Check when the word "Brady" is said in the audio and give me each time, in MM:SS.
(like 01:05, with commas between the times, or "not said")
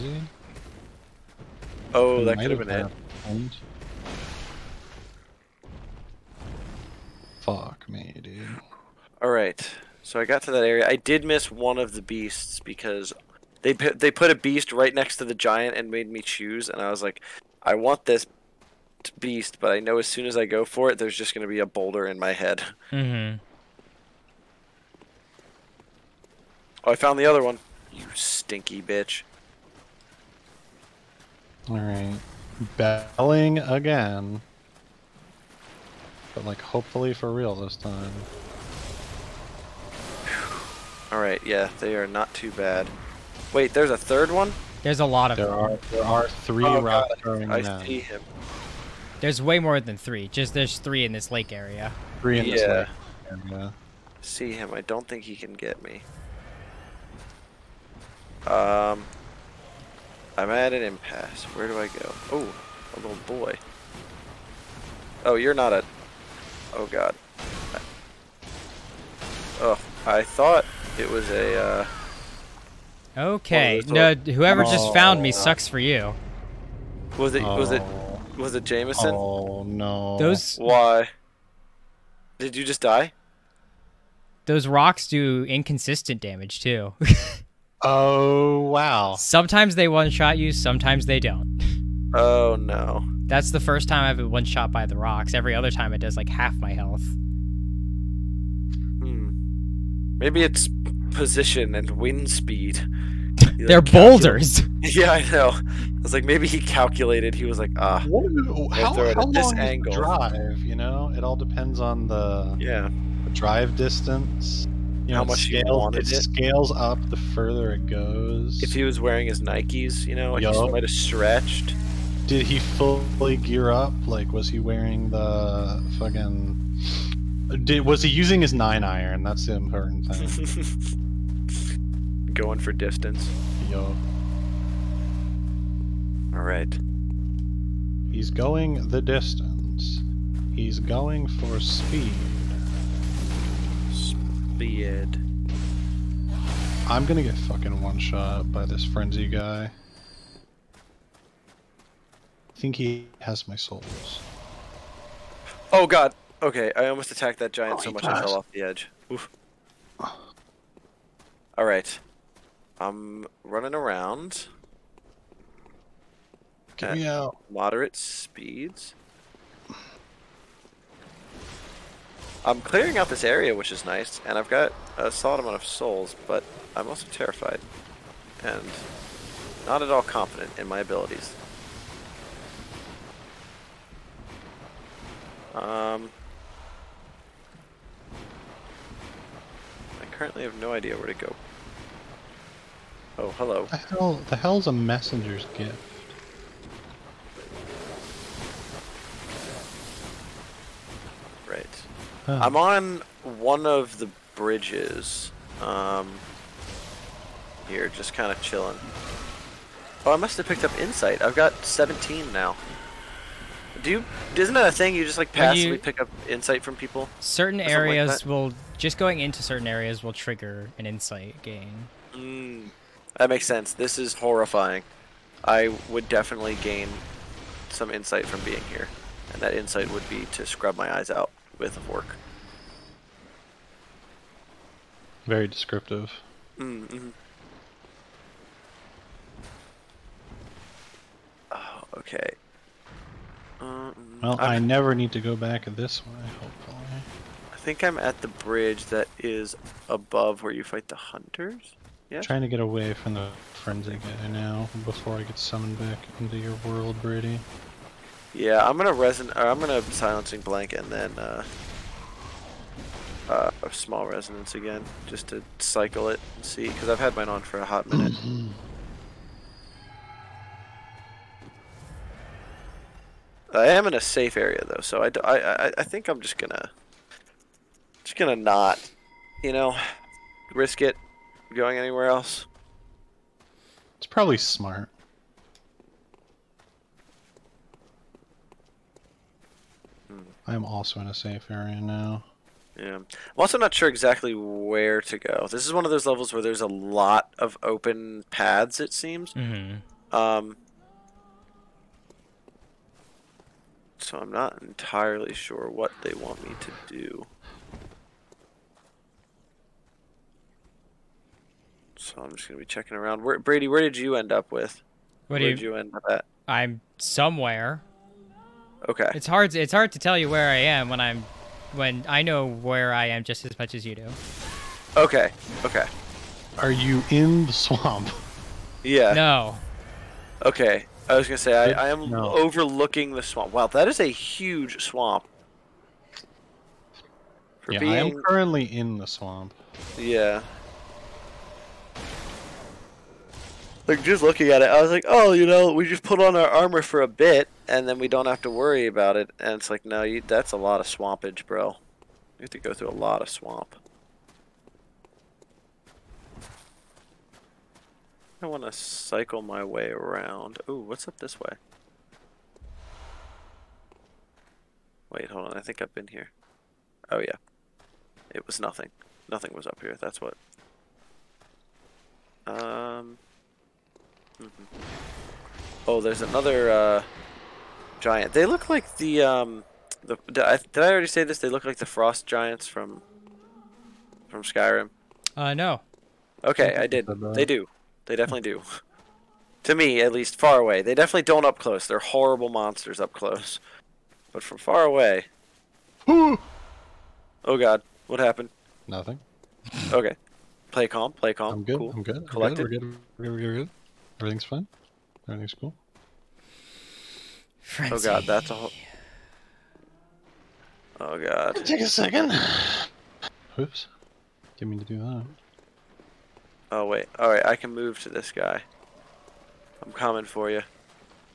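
04:17, 05:13.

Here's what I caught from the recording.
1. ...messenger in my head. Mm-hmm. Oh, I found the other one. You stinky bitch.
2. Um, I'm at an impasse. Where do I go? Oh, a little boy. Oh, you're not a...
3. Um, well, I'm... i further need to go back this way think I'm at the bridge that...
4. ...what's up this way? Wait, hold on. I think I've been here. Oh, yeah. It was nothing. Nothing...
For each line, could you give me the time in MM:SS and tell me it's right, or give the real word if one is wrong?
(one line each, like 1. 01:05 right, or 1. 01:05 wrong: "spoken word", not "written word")
1. 00:21 wrong: "boulder", not "messenger"
2. 00:58 right
3. 04:03 wrong: "never", not "further"
4. 06:00 right.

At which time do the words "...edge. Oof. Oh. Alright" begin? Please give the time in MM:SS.
02:38.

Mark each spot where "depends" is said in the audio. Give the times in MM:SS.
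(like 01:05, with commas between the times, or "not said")
01:51.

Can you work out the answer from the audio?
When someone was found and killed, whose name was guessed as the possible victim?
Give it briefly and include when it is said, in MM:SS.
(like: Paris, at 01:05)
Jameson, at 01:18.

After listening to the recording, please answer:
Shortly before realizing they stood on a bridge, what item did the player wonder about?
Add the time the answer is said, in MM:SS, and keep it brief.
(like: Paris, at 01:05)
messenger's gift, at 03:14.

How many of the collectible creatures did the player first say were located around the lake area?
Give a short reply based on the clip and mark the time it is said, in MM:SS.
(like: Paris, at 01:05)
3, at 00:50.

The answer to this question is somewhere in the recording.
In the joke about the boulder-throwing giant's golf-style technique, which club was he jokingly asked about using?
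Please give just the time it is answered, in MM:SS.
02:08.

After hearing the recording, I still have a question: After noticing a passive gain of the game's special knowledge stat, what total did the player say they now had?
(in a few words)
17.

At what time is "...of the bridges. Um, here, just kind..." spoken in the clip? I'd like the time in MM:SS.
03:23.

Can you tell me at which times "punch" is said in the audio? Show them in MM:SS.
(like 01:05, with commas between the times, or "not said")
not said.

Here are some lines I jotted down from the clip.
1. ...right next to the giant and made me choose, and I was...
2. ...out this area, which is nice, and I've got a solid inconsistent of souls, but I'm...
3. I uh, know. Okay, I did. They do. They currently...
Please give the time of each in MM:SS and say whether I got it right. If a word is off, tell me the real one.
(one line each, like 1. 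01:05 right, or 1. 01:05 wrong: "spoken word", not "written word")
1. 00:14 right
2. 02:52 wrong: "amount", not "inconsistent"
3. 06:25 wrong: "definitely", not "currently".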